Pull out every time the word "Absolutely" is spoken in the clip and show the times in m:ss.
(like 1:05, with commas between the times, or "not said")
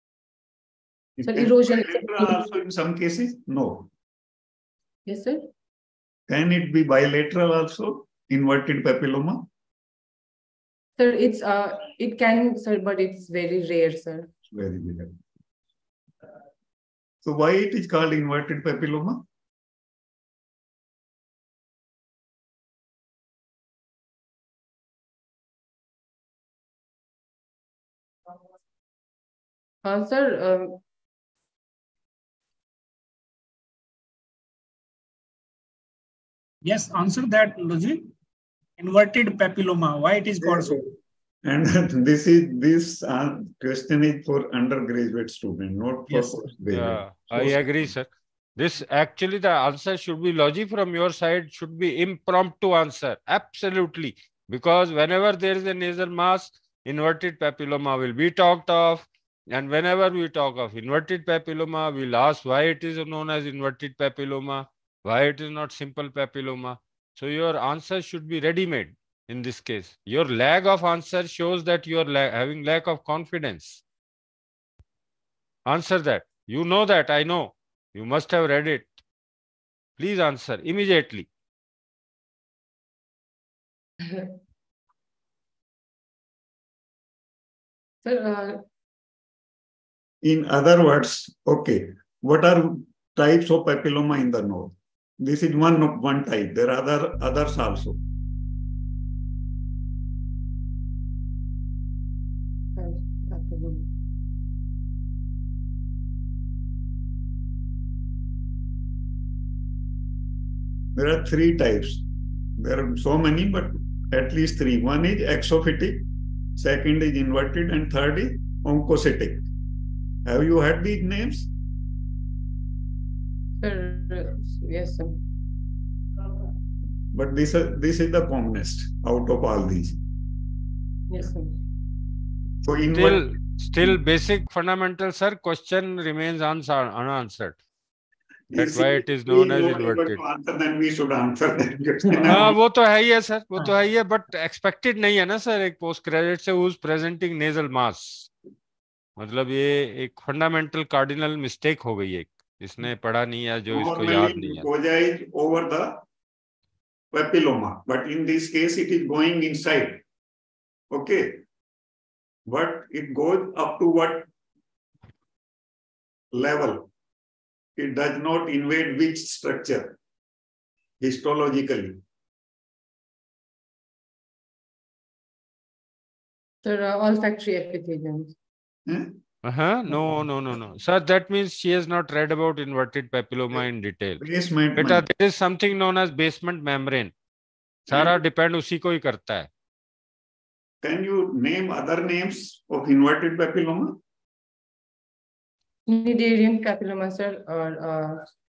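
0:53.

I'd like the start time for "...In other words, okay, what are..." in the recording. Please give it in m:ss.
1:30.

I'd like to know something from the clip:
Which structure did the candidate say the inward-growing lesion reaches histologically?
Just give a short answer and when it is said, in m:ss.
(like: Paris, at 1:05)
olfactory epithelium, at 2:57.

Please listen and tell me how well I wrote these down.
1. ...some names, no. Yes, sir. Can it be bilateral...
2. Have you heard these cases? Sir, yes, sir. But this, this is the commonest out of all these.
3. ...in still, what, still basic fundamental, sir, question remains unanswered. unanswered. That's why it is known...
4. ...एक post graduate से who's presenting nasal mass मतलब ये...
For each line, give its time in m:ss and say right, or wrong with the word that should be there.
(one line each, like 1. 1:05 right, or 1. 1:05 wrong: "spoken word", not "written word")
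1. 0:02 wrong: "cases", not "names"
2. 2:00 wrong: "names", not "cases"
3. 2:12 right
4. 2:25 right.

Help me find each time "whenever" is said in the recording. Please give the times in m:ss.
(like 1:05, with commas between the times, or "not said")
0:54, 0:59.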